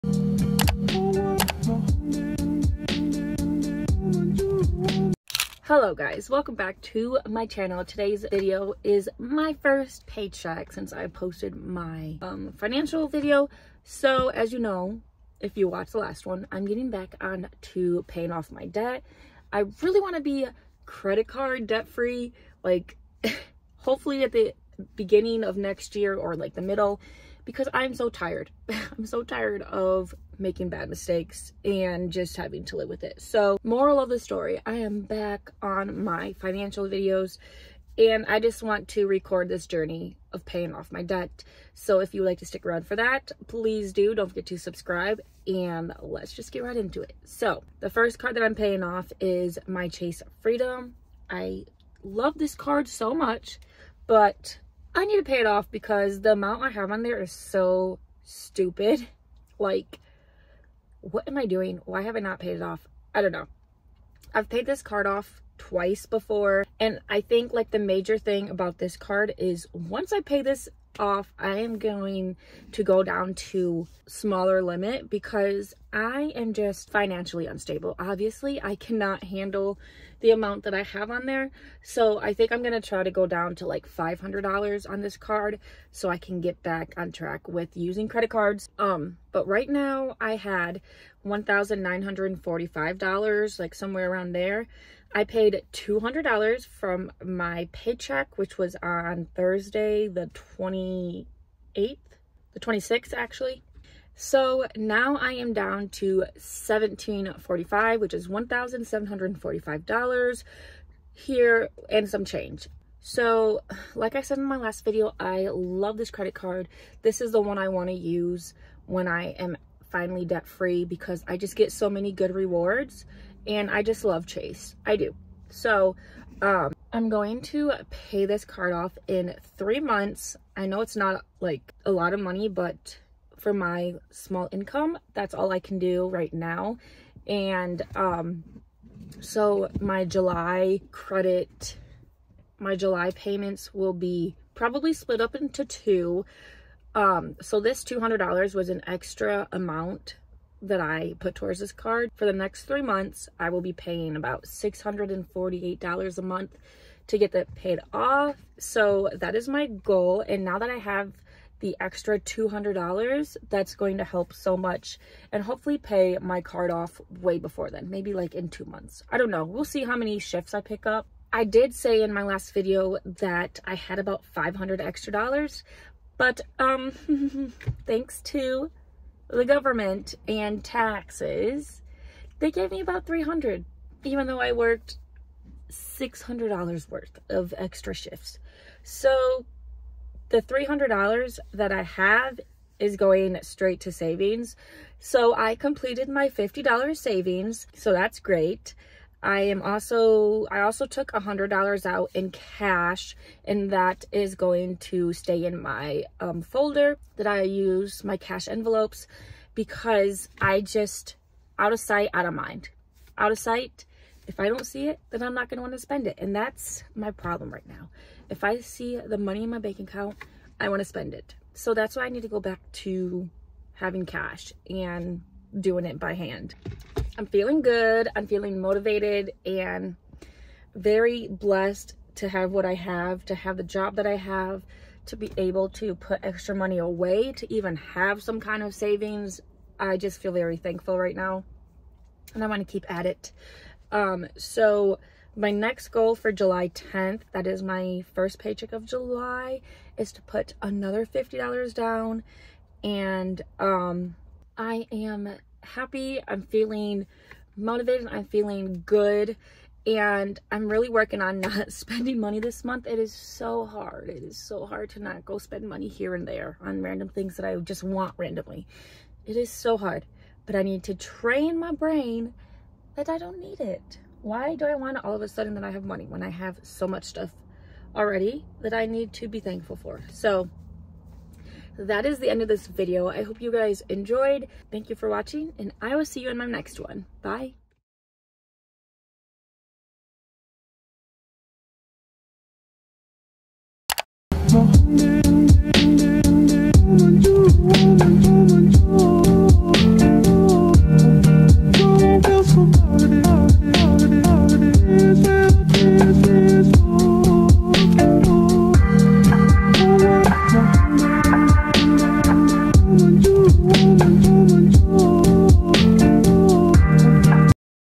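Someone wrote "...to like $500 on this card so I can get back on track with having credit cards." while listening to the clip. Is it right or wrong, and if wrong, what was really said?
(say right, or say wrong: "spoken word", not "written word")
wrong: "using", not "having".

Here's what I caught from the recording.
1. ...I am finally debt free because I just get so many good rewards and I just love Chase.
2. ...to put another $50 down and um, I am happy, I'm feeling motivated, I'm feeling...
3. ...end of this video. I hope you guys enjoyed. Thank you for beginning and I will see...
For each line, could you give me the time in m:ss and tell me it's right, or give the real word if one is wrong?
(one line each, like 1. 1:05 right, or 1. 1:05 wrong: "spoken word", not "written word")
1. 1:59 right
2. 4:10 right
3. 4:42 wrong: "watching", not "beginning".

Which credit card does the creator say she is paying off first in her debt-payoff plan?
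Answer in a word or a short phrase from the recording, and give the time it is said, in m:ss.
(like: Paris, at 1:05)
Chase Freedom, at 0:49.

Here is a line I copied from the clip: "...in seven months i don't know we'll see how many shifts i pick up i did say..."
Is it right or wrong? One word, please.
wrong.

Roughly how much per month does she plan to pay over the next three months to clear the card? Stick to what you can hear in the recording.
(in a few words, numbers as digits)
$648.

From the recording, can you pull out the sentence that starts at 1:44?
So now I am down to $1745, which is $1,745 here and some change.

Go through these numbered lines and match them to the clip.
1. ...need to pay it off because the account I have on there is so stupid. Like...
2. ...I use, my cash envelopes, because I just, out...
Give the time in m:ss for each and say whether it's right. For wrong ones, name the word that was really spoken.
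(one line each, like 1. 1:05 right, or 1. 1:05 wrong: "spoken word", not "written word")
1. 0:55 wrong: "amount", not "account"
2. 3:27 right.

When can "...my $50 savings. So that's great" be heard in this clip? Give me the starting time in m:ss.
3:16.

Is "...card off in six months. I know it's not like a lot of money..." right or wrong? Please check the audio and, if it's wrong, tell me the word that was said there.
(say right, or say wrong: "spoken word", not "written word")
wrong: "three", not "six".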